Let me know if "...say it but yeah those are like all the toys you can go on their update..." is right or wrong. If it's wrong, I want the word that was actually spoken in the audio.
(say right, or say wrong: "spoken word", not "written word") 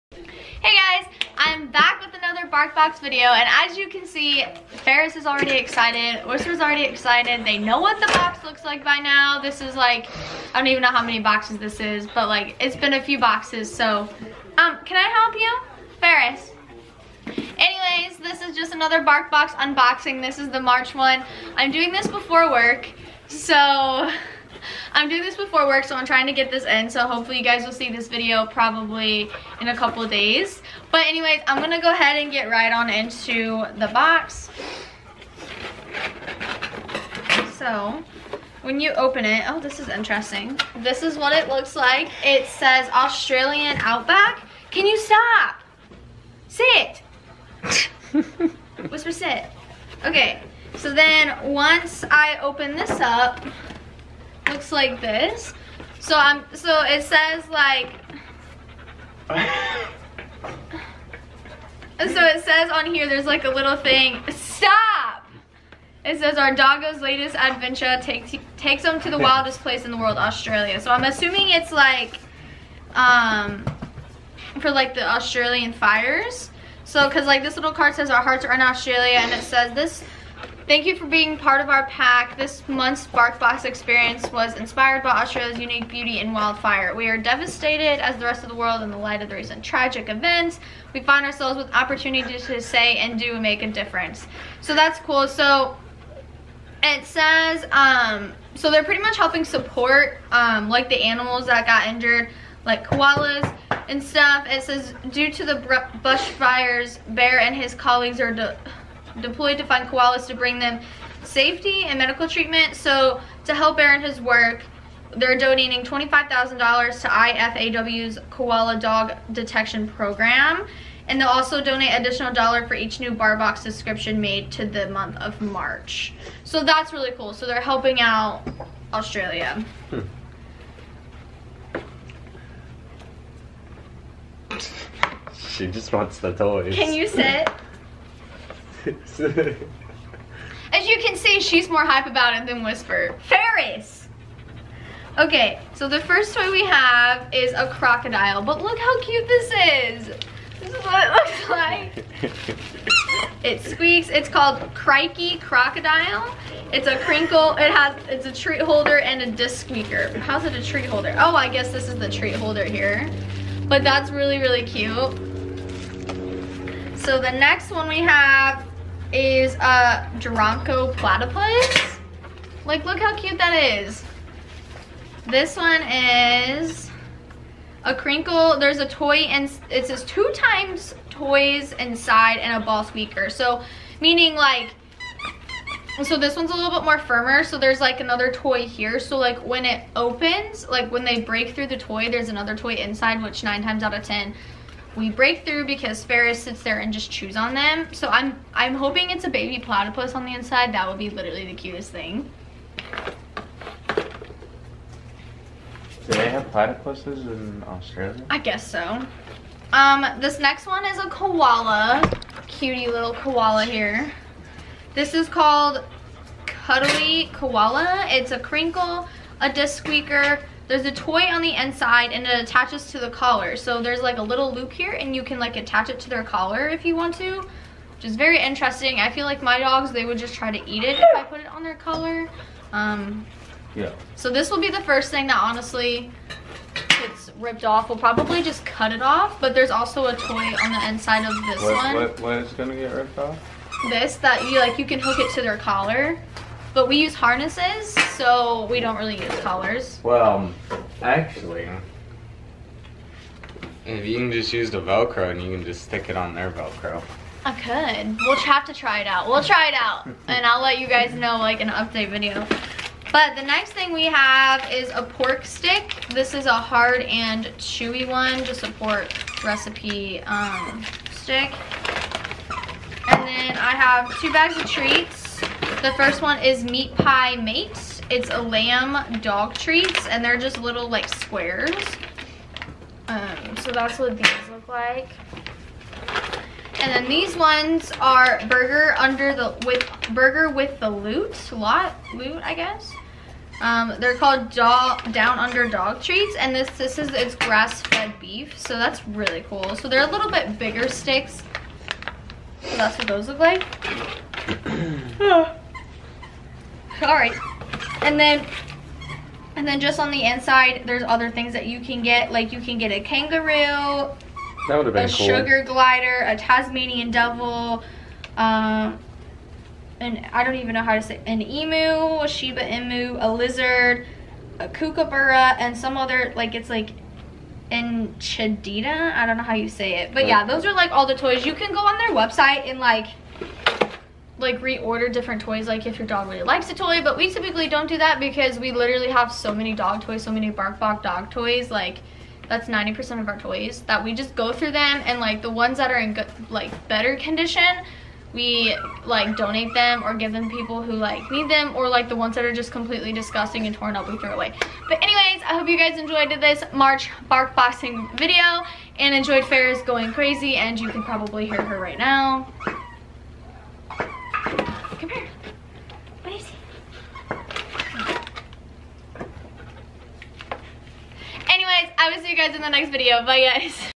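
wrong: "website", not "update".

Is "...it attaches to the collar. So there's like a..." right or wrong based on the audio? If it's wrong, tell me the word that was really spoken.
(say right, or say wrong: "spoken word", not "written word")
right.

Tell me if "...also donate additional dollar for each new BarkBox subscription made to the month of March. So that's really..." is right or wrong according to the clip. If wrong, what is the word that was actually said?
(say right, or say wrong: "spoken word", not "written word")
right.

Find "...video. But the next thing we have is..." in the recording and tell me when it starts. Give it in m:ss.
4:22.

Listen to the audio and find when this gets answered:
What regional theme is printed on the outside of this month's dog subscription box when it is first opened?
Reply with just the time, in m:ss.
0:42.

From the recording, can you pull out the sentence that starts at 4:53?
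Um, they're called dog, down under dog treats, and this this is it's grass fed beef, so that's really cool.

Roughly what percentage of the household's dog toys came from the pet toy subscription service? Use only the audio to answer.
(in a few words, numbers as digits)
90%.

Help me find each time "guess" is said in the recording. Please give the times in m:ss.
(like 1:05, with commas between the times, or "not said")
2:41, 3:28, 4:52.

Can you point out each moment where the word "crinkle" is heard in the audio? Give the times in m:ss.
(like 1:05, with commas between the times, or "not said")
2:36, 2:57, 3:38.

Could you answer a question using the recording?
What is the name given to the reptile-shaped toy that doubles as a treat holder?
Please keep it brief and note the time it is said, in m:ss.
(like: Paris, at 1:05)
Crikey Crocodile, at 2:34.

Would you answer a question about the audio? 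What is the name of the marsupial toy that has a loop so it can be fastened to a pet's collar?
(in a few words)
Cuddly Koala.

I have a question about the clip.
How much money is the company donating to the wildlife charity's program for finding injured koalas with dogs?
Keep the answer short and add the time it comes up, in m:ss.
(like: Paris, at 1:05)
$25,000, at 1:55.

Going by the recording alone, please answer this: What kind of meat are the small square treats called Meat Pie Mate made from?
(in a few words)
Lamb.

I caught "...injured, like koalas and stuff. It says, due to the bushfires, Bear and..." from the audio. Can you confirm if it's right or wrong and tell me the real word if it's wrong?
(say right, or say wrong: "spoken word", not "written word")
right.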